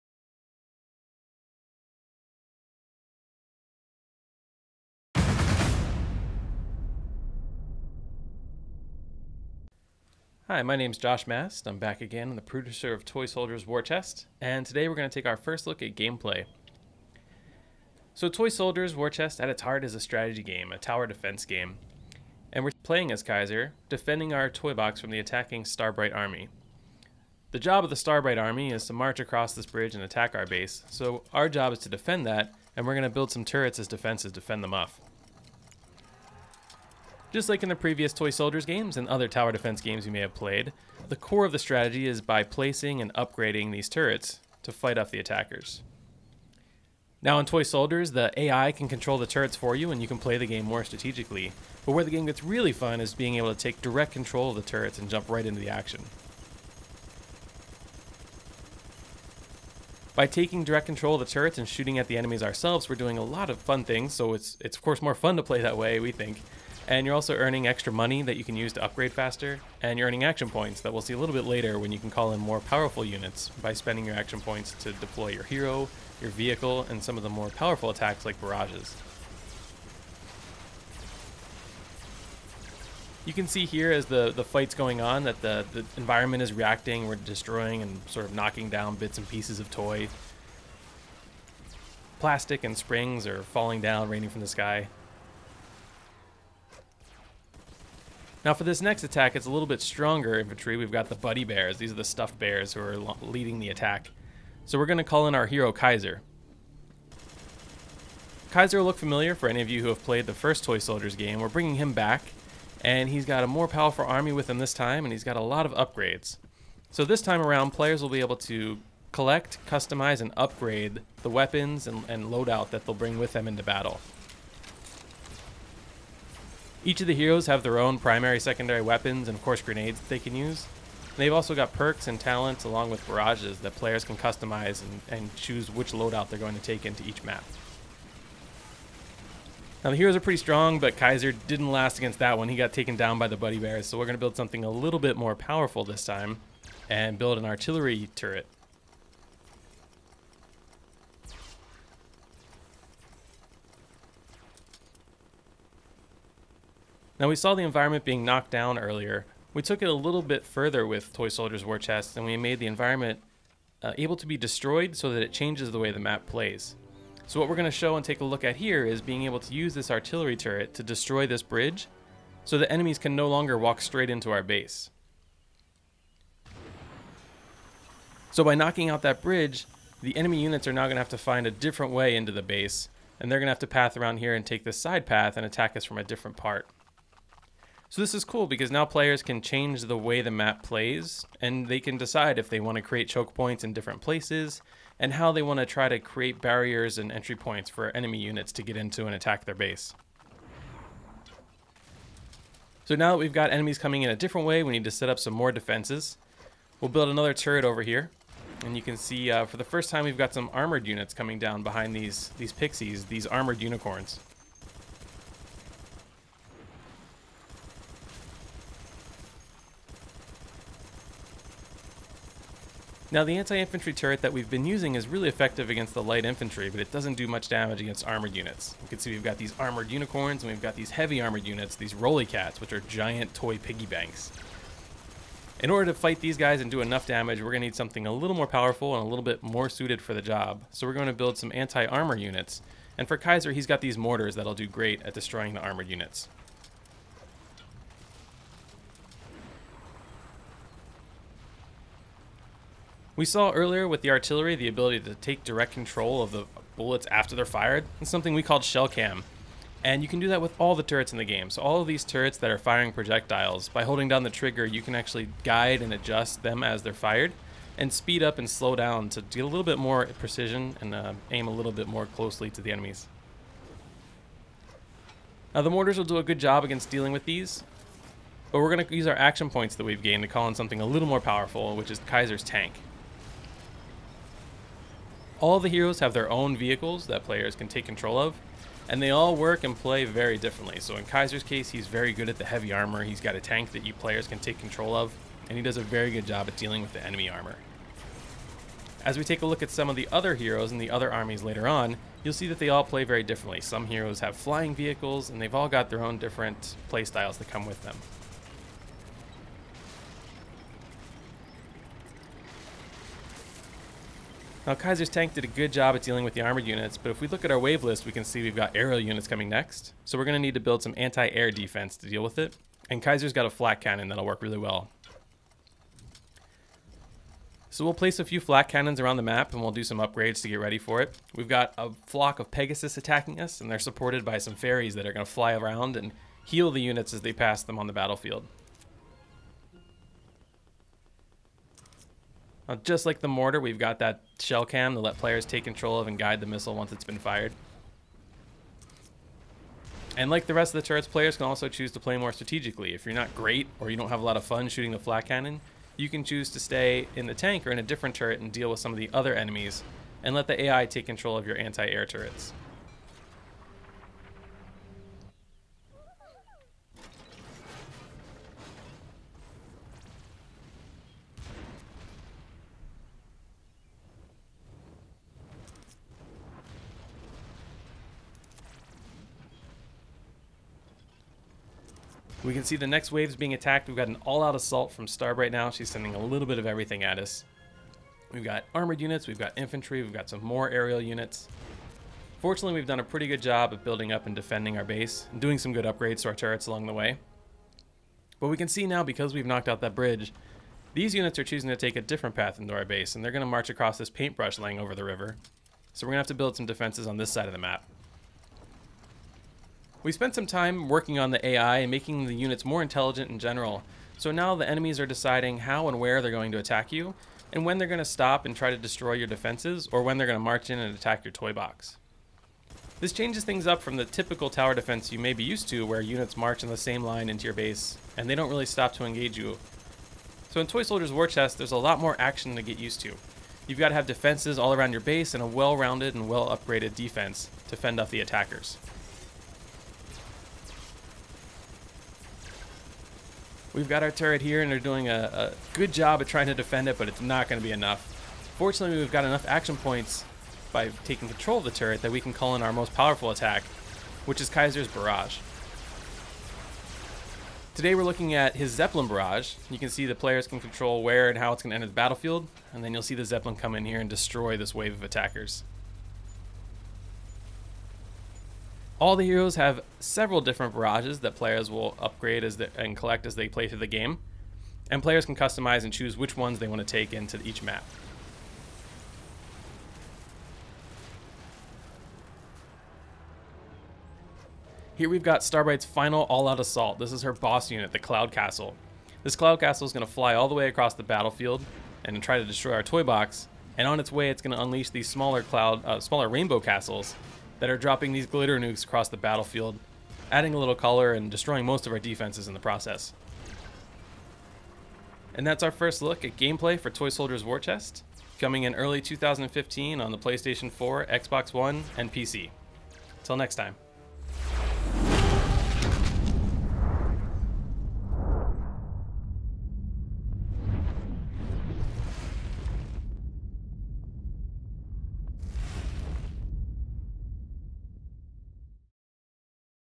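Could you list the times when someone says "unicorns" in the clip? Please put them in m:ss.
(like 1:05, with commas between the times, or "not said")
3:33, 3:49.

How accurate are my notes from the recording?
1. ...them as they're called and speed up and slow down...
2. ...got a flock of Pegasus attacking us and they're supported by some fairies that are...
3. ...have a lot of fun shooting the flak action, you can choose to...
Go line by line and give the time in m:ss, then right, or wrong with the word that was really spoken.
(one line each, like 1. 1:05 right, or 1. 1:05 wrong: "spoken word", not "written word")
1. 4:26 wrong: "fired", not "called"
2. 5:31 right
3. 5:54 wrong: "cannon", not "action".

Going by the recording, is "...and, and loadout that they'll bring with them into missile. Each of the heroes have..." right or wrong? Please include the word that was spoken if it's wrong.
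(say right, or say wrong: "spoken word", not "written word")
wrong: "battle", not "missile".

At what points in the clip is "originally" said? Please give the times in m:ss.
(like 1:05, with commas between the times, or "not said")
not said.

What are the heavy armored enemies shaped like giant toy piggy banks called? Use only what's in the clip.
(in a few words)
roly cats.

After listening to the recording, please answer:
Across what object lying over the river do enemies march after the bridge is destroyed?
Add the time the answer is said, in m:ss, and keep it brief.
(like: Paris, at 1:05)
paintbrush, at 6:44.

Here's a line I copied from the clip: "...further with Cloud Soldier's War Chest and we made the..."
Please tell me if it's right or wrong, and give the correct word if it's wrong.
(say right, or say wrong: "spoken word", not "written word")
wrong: "Toy", not "Cloud".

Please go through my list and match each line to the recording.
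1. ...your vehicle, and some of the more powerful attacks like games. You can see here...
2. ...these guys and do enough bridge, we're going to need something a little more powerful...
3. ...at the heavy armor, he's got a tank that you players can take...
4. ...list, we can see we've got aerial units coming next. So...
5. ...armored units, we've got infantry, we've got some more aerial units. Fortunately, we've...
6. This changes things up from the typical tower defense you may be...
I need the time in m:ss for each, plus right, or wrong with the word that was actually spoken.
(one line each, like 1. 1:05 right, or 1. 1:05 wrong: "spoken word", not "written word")
1. 1:16 wrong: "barrages", not "games"
2. 3:56 wrong: "damage", not "bridge"
3. 4:52 right
4. 5:17 right
5. 6:28 right
6. 7:02 right.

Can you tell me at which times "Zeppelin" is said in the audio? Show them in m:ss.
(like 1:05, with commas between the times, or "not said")
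7:38, 7:43.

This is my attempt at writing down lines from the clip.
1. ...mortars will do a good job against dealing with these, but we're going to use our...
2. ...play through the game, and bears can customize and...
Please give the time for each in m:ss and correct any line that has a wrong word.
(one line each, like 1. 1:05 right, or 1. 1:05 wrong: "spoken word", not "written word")
1. 4:35 right
2. 7:53 wrong: "players", not "bears".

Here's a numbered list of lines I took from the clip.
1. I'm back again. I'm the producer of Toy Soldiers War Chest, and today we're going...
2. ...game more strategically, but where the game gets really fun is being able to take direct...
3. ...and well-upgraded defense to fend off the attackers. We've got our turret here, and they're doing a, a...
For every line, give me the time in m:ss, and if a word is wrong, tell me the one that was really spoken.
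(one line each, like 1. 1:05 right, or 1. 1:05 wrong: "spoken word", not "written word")
1. 0:11 right
2. 0:50 right
3. 7:16 right.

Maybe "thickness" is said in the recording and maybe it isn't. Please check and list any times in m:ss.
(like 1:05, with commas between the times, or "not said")
not said.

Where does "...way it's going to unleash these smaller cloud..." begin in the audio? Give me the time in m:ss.
8:14.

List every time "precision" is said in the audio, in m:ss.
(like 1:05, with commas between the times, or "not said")
4:30.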